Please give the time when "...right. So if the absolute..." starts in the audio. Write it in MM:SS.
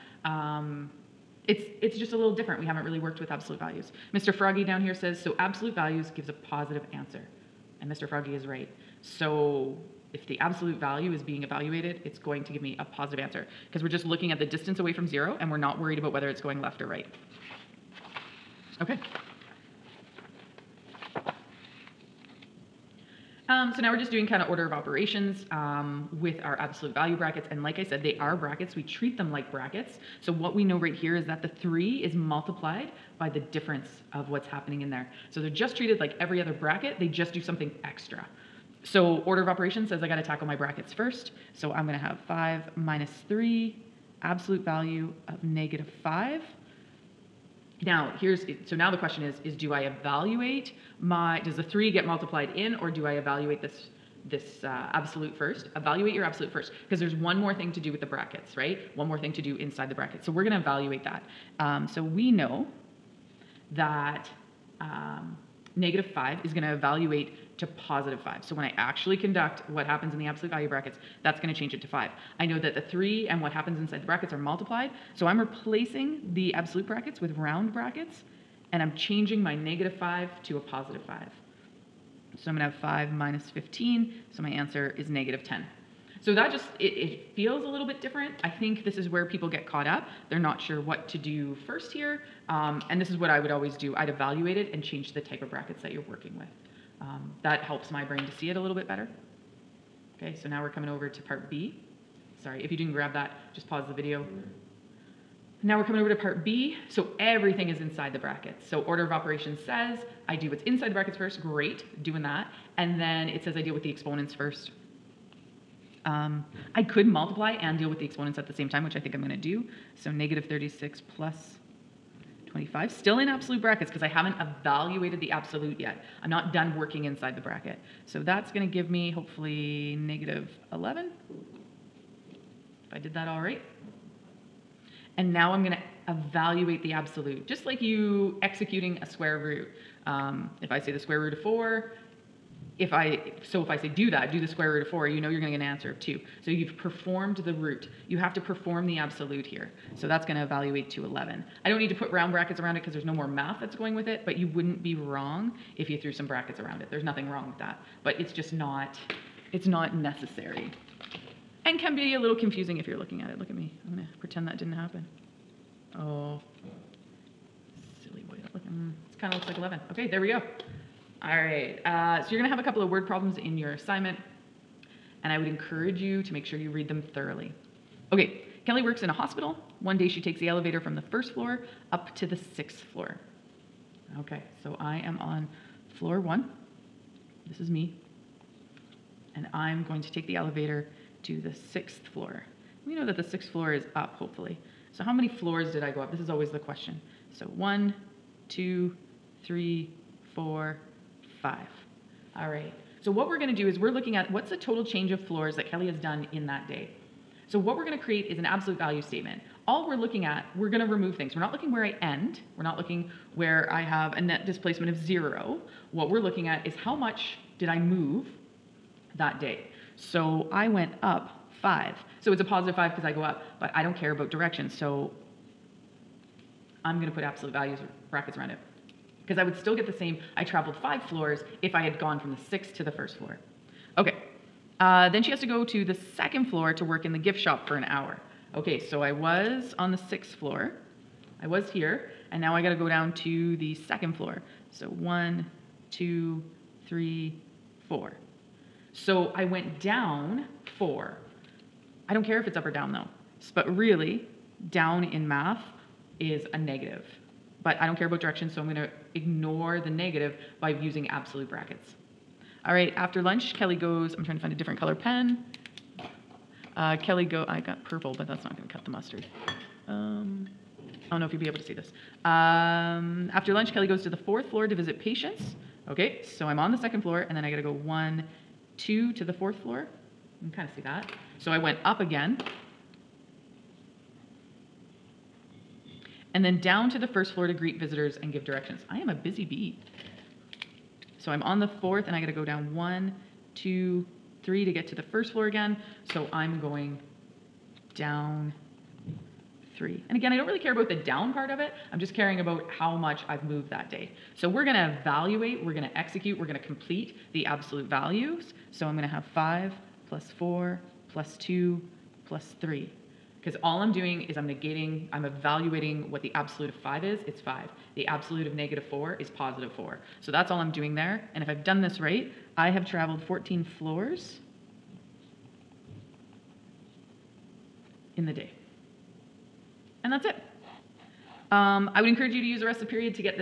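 00:08.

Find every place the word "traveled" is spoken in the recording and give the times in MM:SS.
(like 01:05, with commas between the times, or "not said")
03:50, 05:22.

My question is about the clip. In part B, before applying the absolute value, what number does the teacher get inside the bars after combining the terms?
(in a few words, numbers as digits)
-11.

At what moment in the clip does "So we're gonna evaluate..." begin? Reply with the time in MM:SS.
05:04.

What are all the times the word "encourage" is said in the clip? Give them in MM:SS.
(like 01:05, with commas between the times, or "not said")
02:55, 05:32.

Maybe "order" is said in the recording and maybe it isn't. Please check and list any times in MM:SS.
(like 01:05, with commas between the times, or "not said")
00:24, 00:39, 01:48.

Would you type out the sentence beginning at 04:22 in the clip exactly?
All right, after lunch, Kelly goes, I'm trying to find a different color pen.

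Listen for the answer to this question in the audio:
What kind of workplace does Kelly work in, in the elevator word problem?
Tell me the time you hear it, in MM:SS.
02:59.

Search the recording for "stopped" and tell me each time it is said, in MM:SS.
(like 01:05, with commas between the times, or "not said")
not said.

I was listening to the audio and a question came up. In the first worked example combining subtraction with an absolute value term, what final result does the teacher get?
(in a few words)
-10.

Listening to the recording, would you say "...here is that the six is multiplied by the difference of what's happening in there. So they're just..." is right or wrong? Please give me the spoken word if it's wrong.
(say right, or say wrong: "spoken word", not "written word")
wrong: "three", not "six".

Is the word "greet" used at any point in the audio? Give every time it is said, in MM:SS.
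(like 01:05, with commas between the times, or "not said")
04:47.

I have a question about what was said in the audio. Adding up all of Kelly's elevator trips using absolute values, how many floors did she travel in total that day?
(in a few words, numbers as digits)
14.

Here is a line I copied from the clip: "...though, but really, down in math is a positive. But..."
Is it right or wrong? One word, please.
wrong.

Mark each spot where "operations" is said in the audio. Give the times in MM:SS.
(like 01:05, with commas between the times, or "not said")
00:24, 00:39, 01:49.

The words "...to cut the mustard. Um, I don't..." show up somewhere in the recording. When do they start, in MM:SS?
04:28.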